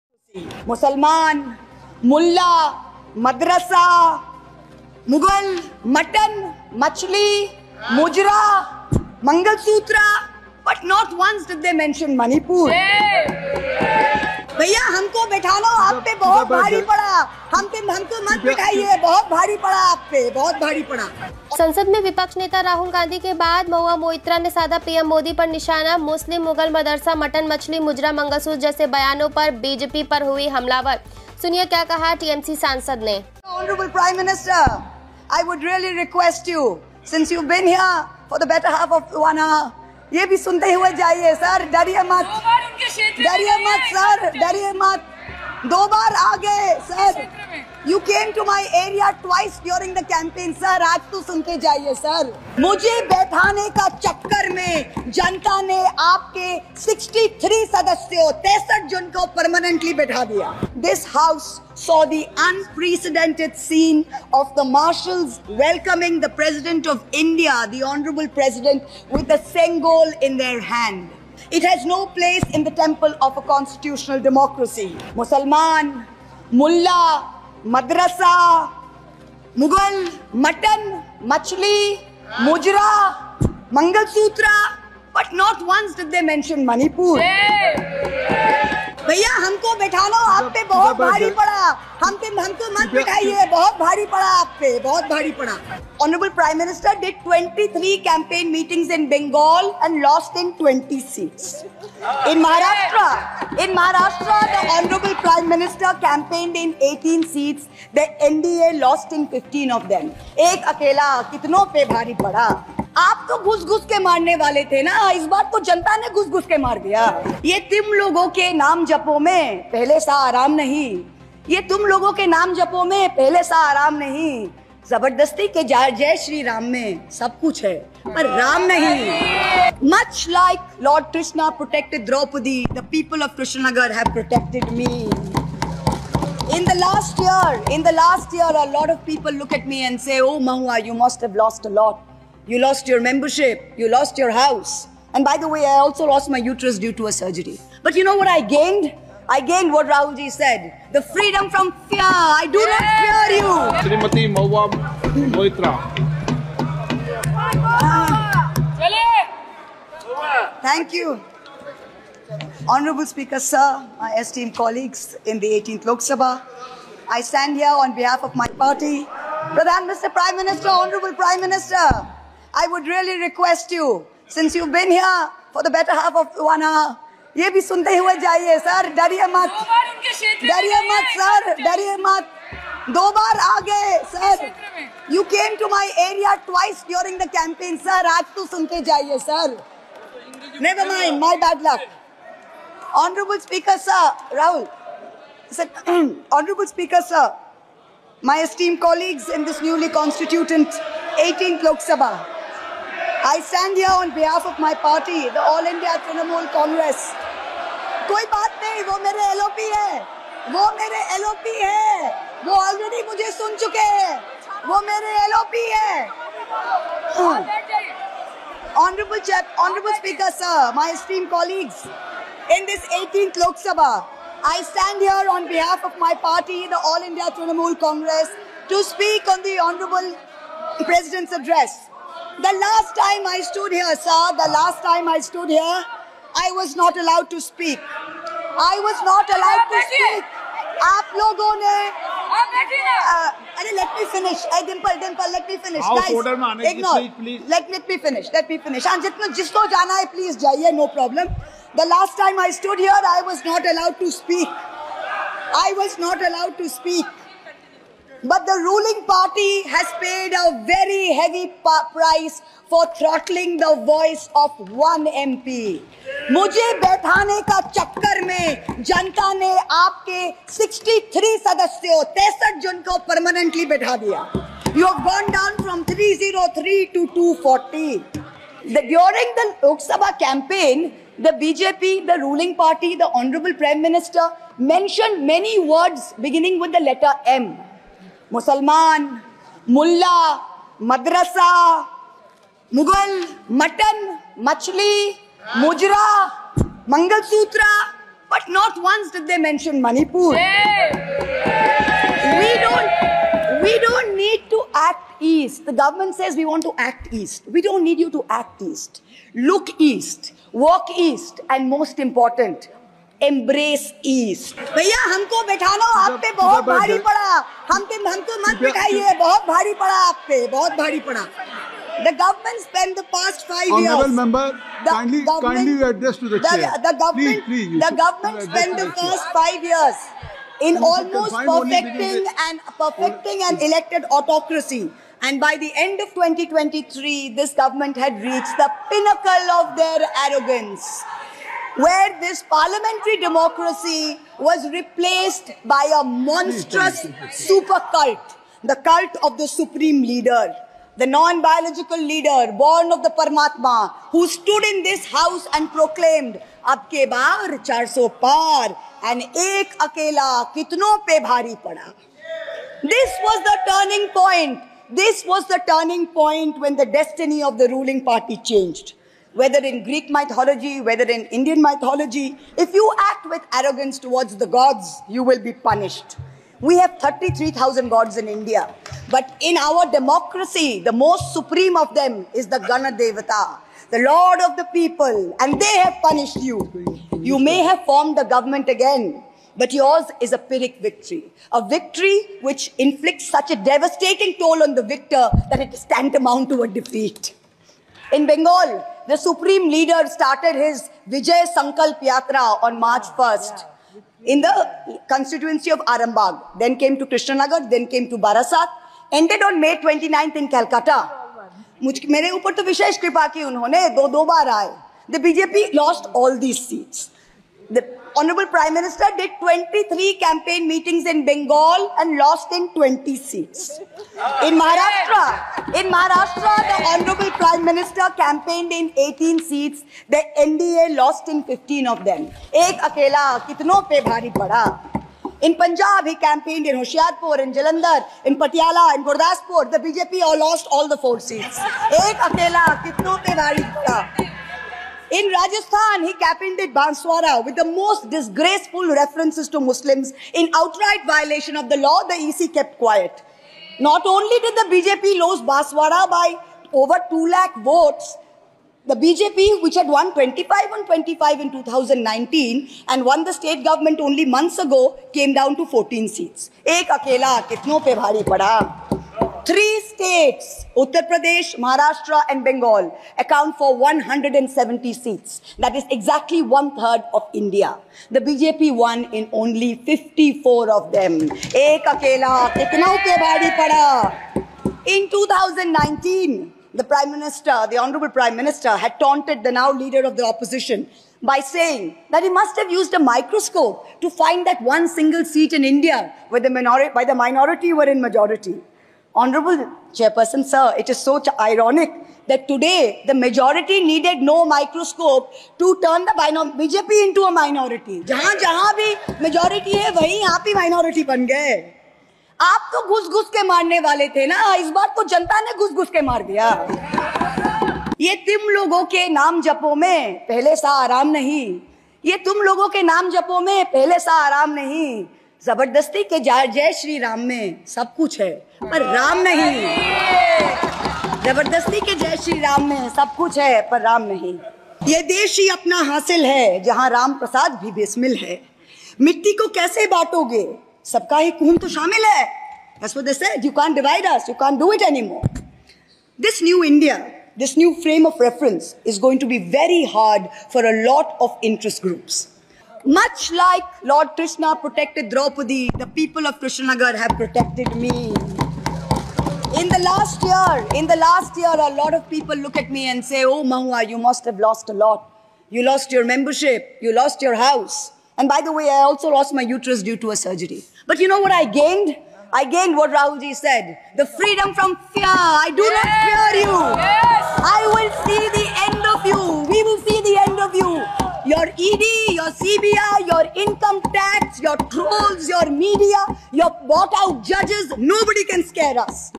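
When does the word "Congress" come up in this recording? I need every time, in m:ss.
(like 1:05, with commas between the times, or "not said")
3:26, 3:47.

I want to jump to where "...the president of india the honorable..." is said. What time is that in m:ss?
1:06.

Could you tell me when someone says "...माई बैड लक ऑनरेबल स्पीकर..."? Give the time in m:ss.
3:11.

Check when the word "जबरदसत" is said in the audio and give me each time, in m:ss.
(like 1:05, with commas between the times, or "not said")
2:04, 8:45, 8:51.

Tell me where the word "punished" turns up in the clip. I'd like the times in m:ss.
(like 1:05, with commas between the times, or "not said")
6:15, 6:26.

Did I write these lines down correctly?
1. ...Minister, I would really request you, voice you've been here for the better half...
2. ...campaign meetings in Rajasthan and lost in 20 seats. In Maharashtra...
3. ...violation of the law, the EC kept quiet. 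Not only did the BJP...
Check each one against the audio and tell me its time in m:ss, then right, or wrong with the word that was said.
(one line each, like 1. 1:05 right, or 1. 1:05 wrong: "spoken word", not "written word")
1. 2:51 wrong: "since", not "voice"
2. 7:00 wrong: "Bengal", not "Rajasthan"
3. 7:31 right.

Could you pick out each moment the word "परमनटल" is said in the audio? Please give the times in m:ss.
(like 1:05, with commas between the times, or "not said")
0:59, 4:33.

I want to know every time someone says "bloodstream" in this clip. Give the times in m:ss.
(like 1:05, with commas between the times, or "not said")
not said.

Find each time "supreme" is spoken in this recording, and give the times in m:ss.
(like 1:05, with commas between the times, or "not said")
5:49, 6:21, 6:39.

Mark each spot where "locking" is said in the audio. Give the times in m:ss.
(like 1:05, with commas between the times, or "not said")
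not said.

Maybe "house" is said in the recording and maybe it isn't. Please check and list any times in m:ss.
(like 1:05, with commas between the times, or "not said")
2:24, 5:55, 9:27.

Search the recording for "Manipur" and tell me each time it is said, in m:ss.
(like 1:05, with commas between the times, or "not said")
0:12, 1:26, 4:59.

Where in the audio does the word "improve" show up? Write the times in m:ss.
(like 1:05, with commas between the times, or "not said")
not said.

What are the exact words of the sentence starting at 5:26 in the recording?
The government, please, please, the government spent the first five years in almost perfecting and perfecting an elected autocracy.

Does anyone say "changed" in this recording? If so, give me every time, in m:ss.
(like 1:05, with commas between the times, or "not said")
6:08.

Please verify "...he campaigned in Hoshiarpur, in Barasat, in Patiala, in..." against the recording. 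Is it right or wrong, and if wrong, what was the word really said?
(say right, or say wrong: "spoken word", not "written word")
wrong: "Jalandhar", not "Barasat".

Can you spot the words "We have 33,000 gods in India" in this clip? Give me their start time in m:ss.
6:16.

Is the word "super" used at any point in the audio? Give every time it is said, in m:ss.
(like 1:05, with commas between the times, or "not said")
5:47.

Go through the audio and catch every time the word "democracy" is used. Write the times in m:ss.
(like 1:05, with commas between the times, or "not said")
1:14, 5:43, 6:19.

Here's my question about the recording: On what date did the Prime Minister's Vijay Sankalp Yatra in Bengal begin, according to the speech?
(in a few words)
March 1st.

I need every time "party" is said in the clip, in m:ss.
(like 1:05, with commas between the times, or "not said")
2:48, 3:24, 3:46, 4:19, 4:42, 6:08.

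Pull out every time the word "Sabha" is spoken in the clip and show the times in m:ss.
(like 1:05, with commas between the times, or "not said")
2:45, 3:21, 3:43, 4:39.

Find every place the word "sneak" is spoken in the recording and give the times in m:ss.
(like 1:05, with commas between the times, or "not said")
not said.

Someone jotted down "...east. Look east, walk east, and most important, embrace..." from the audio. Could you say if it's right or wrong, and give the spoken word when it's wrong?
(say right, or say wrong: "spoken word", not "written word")
right.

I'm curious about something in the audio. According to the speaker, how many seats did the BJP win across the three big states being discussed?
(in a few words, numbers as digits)
54.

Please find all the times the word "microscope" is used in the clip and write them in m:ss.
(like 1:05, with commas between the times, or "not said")
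8:12, 8:24.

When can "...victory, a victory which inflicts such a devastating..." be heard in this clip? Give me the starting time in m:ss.
6:30.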